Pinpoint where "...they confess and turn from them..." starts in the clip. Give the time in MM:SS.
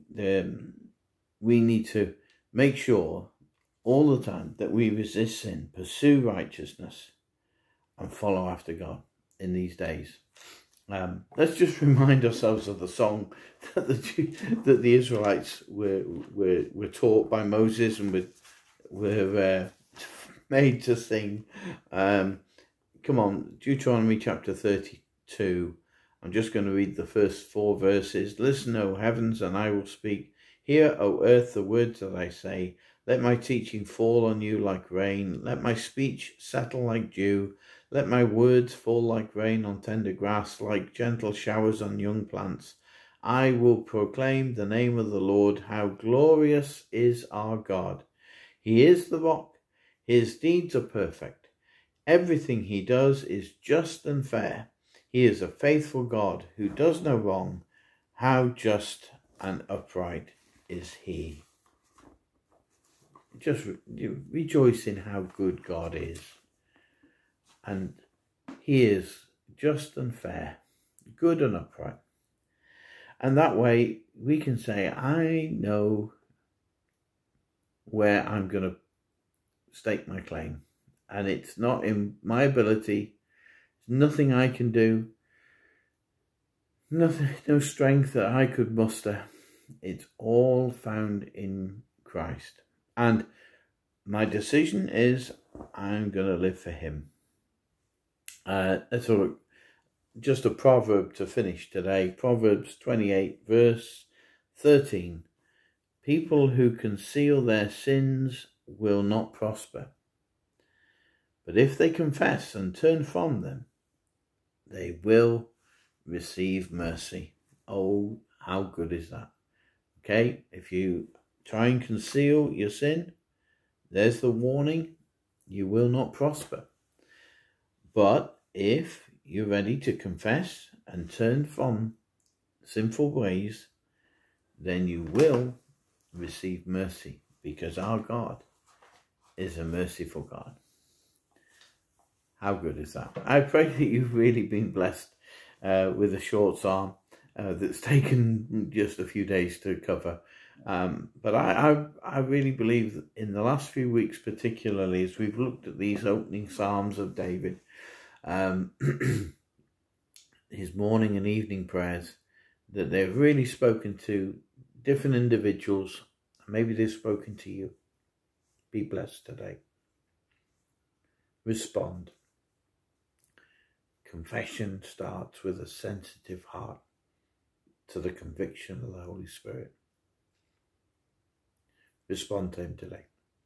01:51.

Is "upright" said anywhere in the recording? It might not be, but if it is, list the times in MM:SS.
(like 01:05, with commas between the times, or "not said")
00:59, 01:11.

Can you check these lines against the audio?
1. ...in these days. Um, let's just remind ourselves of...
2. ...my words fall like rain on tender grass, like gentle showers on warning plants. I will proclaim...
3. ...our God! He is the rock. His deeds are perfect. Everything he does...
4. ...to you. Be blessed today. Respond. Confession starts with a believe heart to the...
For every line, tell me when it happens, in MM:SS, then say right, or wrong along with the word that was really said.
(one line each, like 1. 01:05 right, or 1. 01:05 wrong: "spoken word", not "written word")
1. 00:09 right
2. 00:38 wrong: "young", not "warning"
3. 00:47 right
4. 02:47 wrong: "sensitive", not "believe".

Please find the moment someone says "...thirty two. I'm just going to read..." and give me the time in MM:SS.
00:24.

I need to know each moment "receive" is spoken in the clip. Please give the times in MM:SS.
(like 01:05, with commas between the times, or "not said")
01:56, 02:16.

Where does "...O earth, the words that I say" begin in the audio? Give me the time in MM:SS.
00:30.